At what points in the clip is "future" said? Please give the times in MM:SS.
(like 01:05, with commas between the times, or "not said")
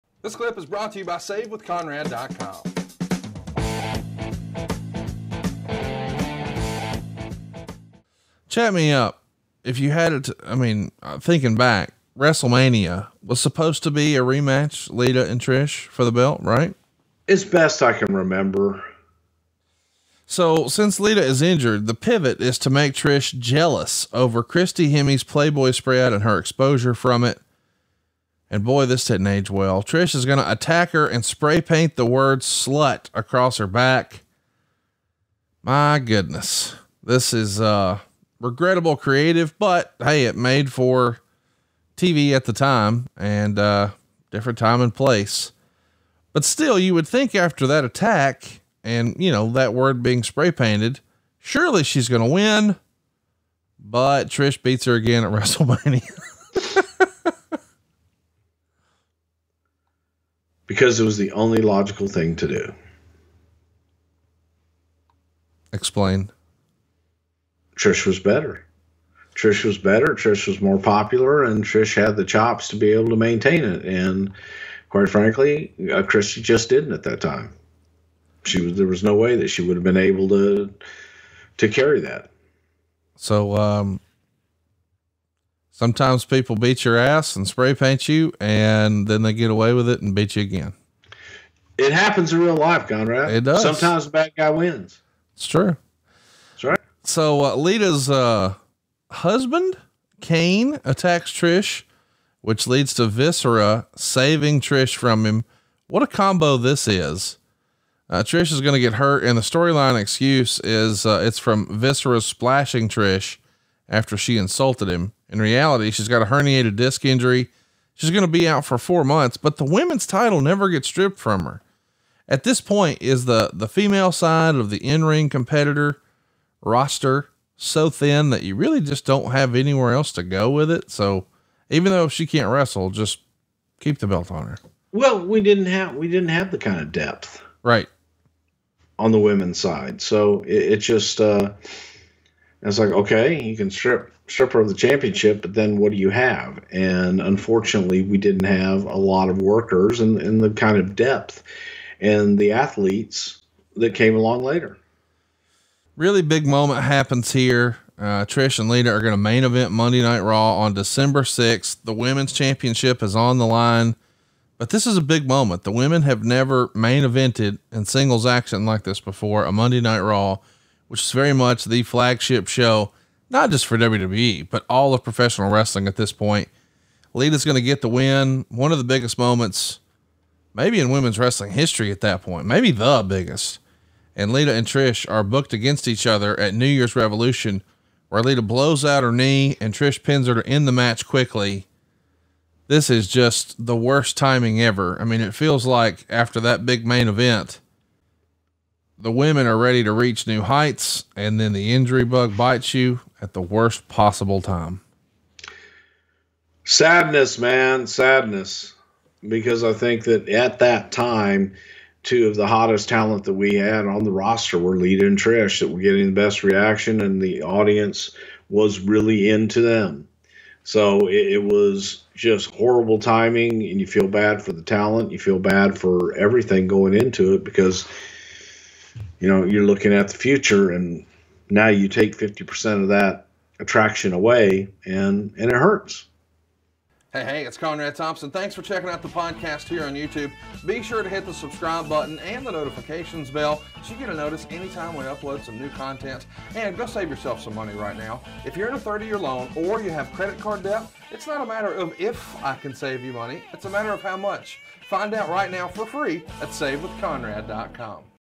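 03:50.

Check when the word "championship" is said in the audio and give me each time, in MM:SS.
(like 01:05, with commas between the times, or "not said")
02:24, 02:42.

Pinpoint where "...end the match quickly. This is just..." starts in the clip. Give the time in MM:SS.
03:10.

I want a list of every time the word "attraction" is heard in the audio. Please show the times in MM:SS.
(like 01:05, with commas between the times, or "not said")
03:53.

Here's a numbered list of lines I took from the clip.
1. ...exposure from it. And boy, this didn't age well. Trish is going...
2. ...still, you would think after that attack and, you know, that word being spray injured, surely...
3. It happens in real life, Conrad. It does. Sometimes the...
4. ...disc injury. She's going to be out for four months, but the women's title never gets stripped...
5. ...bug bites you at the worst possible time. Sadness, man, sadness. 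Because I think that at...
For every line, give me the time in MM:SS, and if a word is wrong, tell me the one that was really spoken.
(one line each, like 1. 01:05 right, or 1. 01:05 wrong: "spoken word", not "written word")
1. 00:26 right
2. 00:46 wrong: "painted", not "injured"
3. 01:31 right
4. 01:56 right
5. 03:22 right.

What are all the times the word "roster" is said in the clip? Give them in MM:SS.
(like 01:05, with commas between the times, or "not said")
02:06, 03:34.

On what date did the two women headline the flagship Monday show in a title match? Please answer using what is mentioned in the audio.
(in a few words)
December 6th.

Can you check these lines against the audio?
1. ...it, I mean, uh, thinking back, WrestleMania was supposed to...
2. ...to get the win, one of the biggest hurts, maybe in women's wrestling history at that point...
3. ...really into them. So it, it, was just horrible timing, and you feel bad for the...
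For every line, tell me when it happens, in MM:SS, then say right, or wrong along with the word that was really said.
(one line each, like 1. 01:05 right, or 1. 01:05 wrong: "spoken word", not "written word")
1. 00:10 right
2. 02:57 wrong: "moments", not "hurts"
3. 03:38 right.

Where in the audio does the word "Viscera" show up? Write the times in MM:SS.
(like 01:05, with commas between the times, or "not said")
01:43, 01:51.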